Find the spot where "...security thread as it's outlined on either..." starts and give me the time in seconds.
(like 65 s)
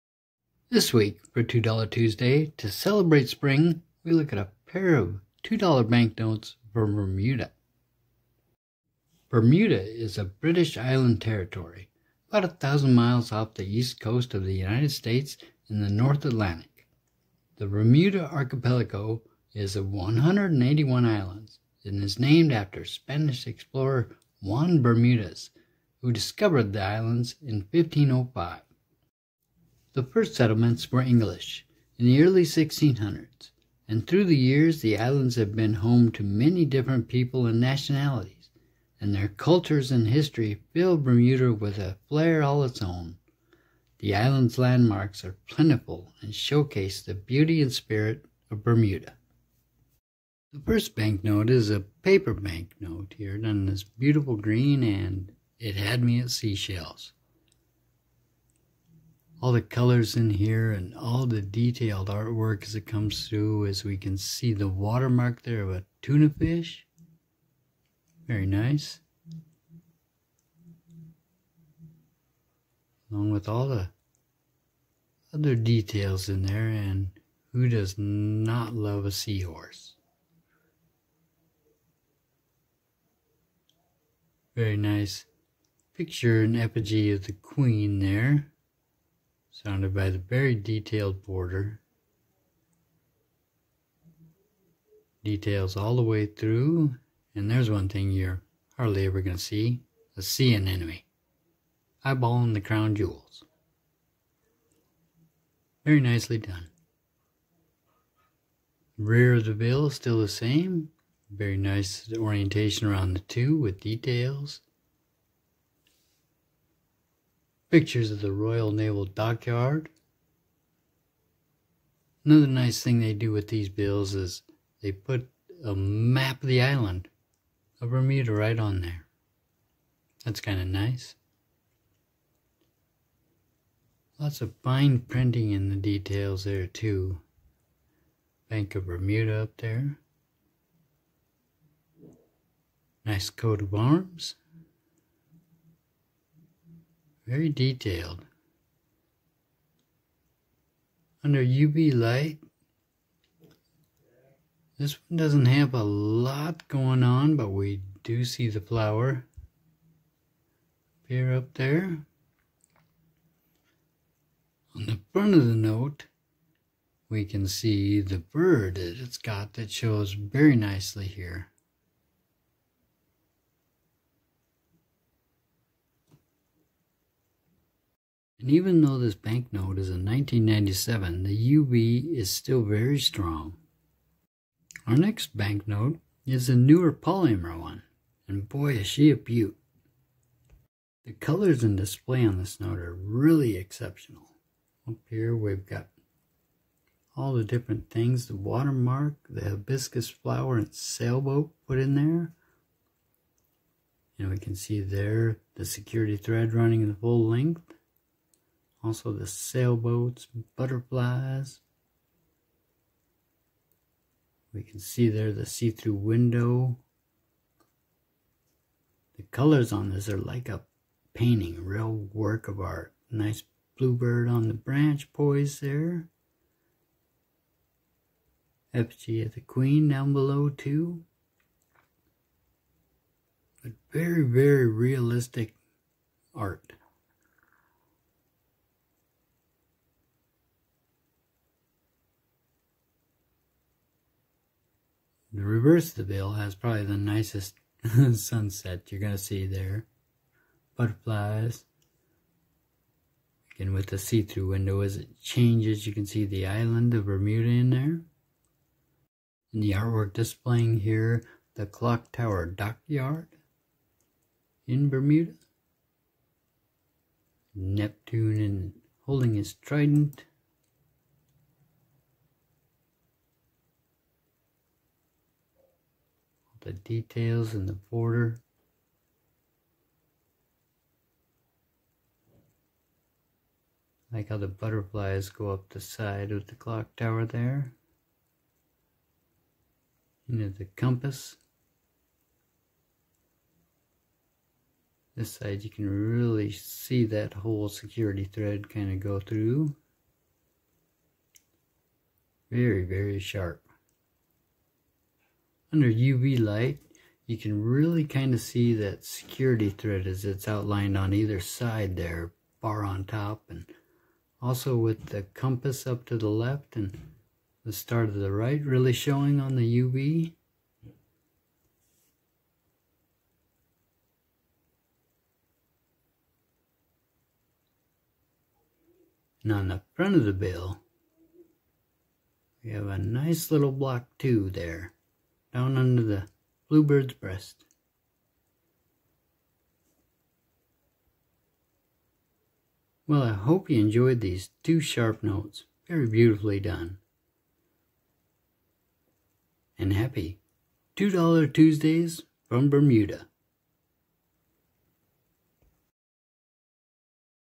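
309 s.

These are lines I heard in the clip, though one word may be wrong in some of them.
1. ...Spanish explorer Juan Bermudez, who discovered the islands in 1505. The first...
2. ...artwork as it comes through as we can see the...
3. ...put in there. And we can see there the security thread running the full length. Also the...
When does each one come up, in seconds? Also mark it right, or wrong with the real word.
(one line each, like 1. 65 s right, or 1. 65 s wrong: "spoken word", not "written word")
1. 22 s right
2. 62 s right
3. 201 s right.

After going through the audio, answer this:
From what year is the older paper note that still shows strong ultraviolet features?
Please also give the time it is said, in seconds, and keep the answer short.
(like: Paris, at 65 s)
1997, at 180 s.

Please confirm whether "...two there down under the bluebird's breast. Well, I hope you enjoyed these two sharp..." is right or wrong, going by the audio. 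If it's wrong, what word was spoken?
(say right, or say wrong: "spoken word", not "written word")
right.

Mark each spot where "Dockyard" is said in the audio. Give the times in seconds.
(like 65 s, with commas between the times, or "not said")
119 s, 262 s.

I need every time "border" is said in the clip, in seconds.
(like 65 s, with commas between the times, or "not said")
91 s, 277 s.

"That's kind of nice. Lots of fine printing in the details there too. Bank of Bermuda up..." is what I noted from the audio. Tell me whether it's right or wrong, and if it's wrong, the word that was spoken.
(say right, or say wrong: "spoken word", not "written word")
right.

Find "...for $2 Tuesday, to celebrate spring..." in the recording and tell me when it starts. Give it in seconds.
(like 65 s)
1 s.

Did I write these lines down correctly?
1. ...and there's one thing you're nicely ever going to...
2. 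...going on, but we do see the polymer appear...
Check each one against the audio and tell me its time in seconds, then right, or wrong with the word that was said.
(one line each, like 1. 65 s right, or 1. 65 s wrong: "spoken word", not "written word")
1. 97 s wrong: "hardly", not "nicely"
2. 156 s wrong: "flower", not "polymer".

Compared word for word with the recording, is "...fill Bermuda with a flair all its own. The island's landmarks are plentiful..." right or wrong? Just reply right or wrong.
right.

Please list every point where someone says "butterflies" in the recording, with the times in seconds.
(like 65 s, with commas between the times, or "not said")
210 s, 250 s, 284 s.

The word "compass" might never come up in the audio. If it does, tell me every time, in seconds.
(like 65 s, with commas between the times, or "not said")
290 s, 315 s.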